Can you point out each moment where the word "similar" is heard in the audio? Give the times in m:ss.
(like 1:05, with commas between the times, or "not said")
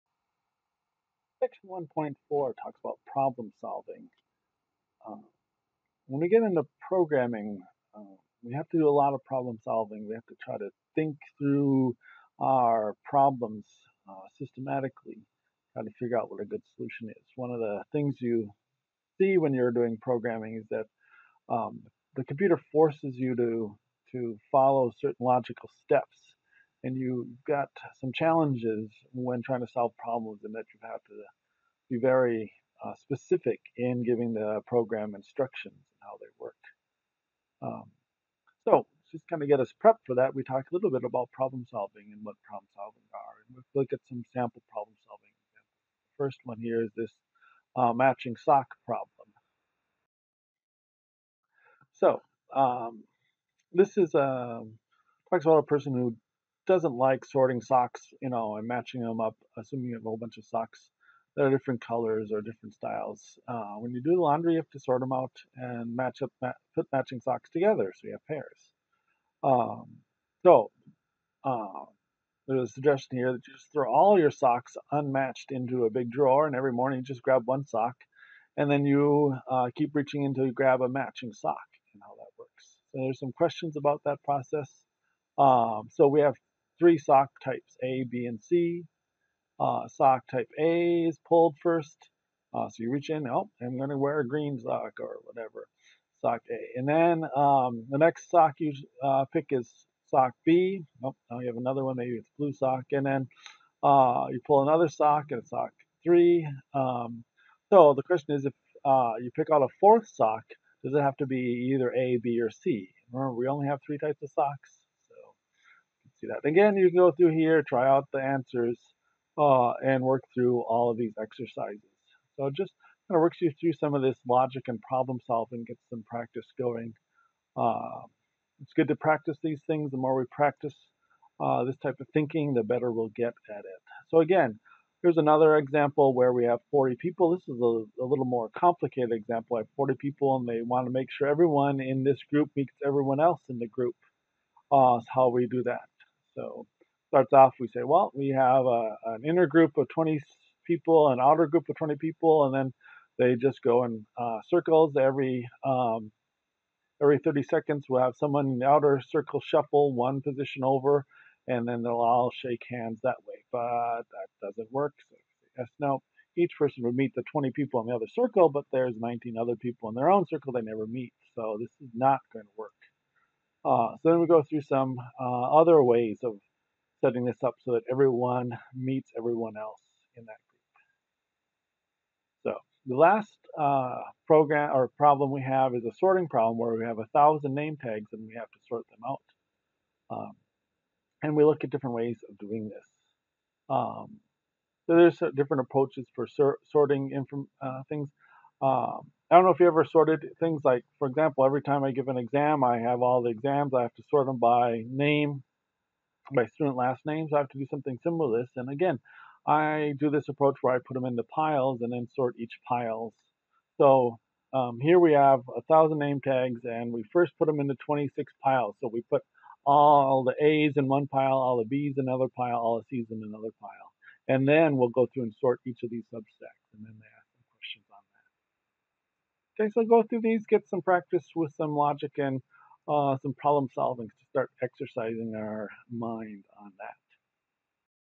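3:28.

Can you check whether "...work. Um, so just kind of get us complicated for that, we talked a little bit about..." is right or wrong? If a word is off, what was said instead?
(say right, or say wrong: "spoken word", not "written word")
wrong: "prepped", not "complicated".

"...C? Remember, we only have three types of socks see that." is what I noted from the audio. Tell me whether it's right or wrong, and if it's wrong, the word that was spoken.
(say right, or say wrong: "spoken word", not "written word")
right.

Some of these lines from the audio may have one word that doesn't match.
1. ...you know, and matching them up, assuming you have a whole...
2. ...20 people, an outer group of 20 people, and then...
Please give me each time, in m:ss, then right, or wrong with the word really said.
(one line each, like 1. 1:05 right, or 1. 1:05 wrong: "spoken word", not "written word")
1. 0:58 right
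2. 2:29 right.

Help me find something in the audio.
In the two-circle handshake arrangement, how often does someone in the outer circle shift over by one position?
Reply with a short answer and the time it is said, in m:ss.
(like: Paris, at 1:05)
every 30 seconds, at 2:37.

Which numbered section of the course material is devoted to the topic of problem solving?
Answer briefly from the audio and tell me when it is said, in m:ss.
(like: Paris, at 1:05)
1.4, at 0:01.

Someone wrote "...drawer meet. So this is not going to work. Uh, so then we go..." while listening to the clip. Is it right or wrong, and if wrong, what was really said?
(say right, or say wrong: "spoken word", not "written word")
wrong: "never", not "drawer".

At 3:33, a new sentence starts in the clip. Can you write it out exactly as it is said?
So um, here we have a thousand name tags, and we first put them into 26 piles.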